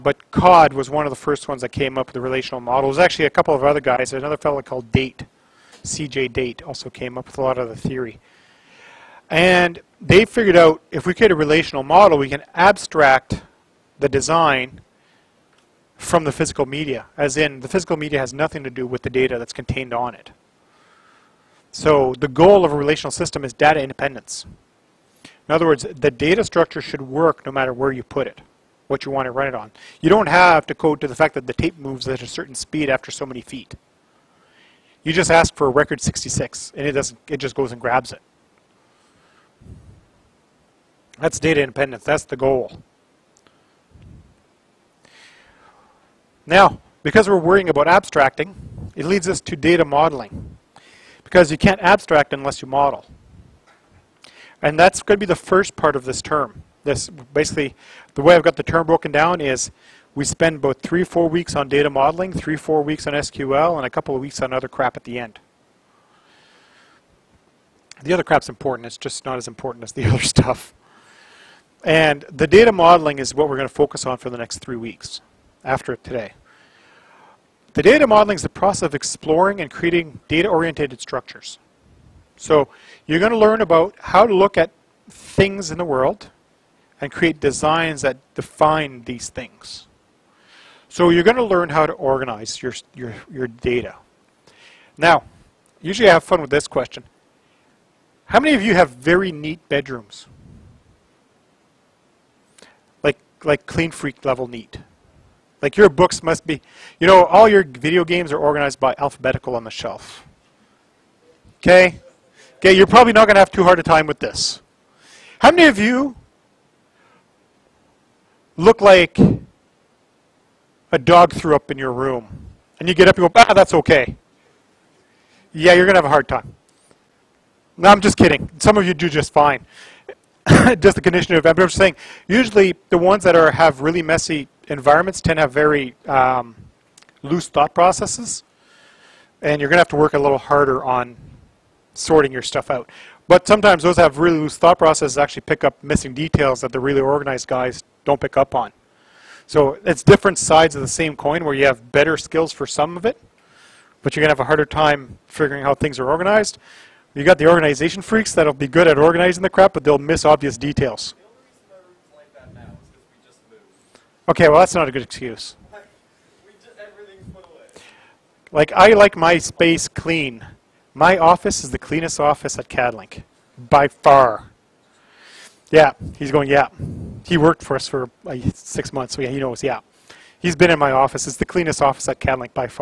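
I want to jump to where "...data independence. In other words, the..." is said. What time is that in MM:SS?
00:23.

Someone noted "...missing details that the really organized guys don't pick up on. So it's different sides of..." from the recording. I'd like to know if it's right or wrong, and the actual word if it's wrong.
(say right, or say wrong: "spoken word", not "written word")
right.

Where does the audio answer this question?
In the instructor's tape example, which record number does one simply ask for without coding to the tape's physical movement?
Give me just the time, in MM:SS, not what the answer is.
00:35.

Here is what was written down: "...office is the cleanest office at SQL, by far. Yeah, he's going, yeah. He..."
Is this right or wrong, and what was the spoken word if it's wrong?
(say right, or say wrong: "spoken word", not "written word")
wrong: "CADLink", not "SQL".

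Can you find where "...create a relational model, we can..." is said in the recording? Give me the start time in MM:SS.
00:11.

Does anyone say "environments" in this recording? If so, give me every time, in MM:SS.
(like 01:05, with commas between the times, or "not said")
02:14.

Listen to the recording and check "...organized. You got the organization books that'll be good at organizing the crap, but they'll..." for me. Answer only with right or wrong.
wrong.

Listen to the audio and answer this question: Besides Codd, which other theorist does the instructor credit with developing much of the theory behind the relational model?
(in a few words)
C.J. Date.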